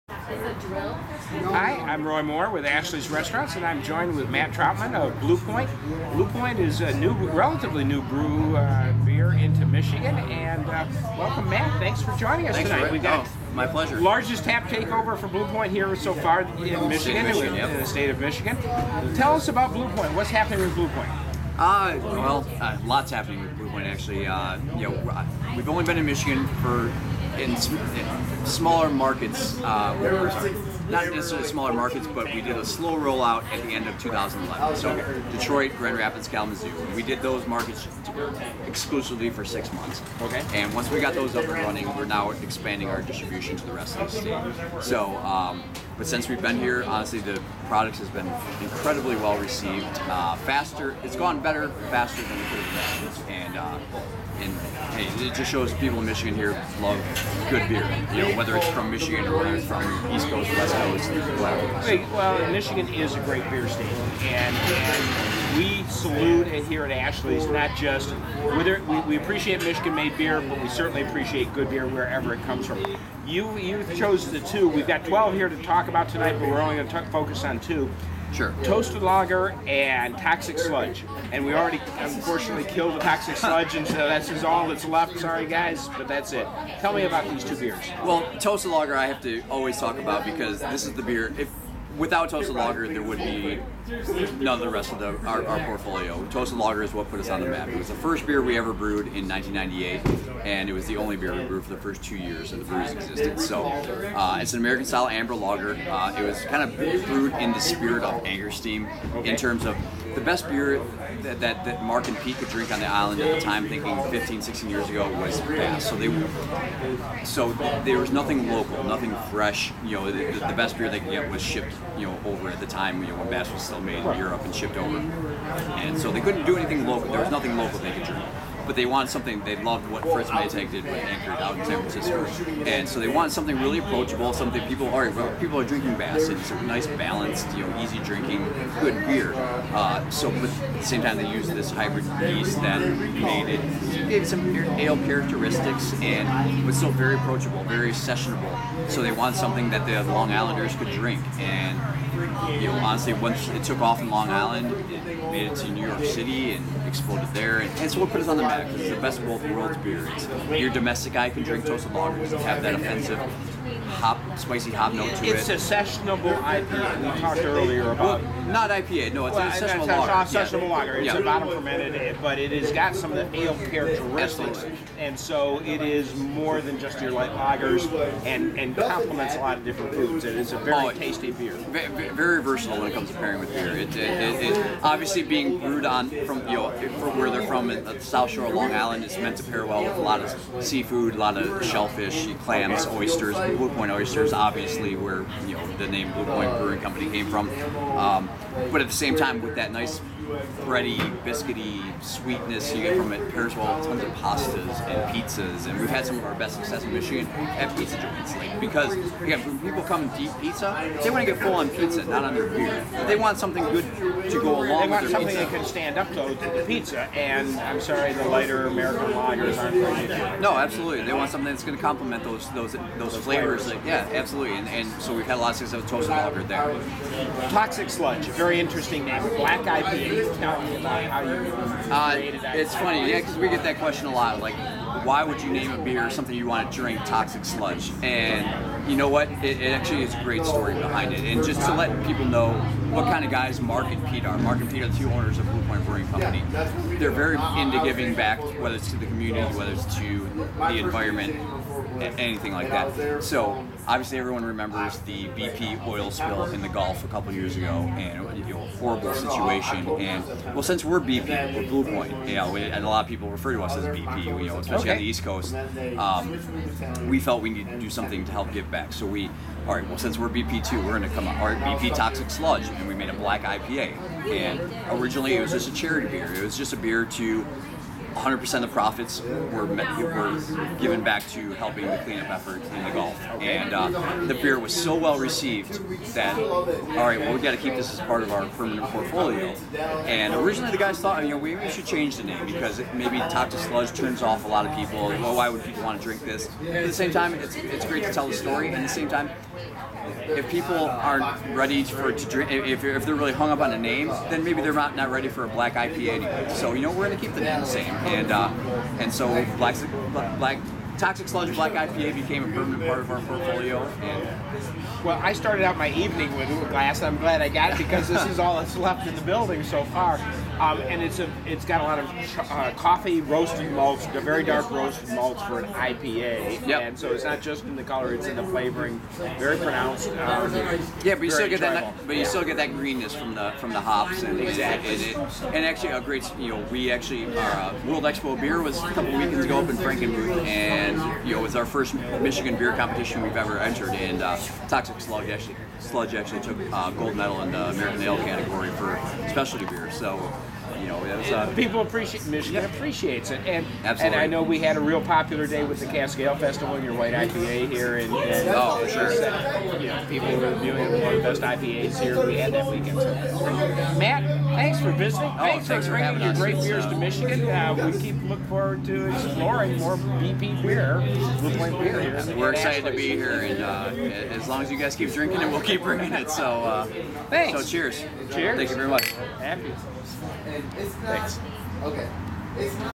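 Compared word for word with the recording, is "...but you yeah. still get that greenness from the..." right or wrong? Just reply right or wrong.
right.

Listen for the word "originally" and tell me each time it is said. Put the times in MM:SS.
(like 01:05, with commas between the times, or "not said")
04:34, 04:50.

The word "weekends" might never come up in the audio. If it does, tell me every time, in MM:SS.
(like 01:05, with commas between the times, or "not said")
05:39, 06:02.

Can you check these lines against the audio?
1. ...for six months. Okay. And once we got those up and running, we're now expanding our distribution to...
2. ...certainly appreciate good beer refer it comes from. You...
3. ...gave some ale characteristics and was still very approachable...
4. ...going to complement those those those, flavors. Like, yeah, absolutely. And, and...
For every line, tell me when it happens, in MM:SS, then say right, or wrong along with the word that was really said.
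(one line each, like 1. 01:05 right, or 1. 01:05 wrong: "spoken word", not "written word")
1. 00:39 right
2. 01:10 wrong: "wherever", not "refer"
3. 02:24 right
4. 03:41 right.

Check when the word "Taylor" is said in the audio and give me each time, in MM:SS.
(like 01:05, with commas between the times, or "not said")
not said.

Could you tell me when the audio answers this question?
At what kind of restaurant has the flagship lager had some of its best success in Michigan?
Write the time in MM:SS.
03:27.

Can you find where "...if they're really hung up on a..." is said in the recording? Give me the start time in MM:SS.
05:02.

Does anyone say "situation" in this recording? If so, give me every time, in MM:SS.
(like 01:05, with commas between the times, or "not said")
04:19.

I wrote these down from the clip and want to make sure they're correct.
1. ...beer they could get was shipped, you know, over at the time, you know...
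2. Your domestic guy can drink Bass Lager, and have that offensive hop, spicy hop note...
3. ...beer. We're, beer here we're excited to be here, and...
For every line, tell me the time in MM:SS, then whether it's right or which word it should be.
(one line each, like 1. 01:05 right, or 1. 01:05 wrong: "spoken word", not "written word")
1. 02:00 right
2. 02:40 wrong: "Toasted", not "Bass"
3. 06:10 right.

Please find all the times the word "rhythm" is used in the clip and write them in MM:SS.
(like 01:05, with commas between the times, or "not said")
not said.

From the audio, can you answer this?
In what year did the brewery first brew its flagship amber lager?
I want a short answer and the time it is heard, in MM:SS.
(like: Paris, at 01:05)
1998, at 01:39.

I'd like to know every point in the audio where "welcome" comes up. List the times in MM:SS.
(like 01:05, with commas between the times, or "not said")
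00:11.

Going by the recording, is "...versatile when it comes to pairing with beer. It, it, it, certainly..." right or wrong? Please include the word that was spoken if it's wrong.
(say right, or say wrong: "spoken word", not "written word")
wrong: "obviously", not "certainly".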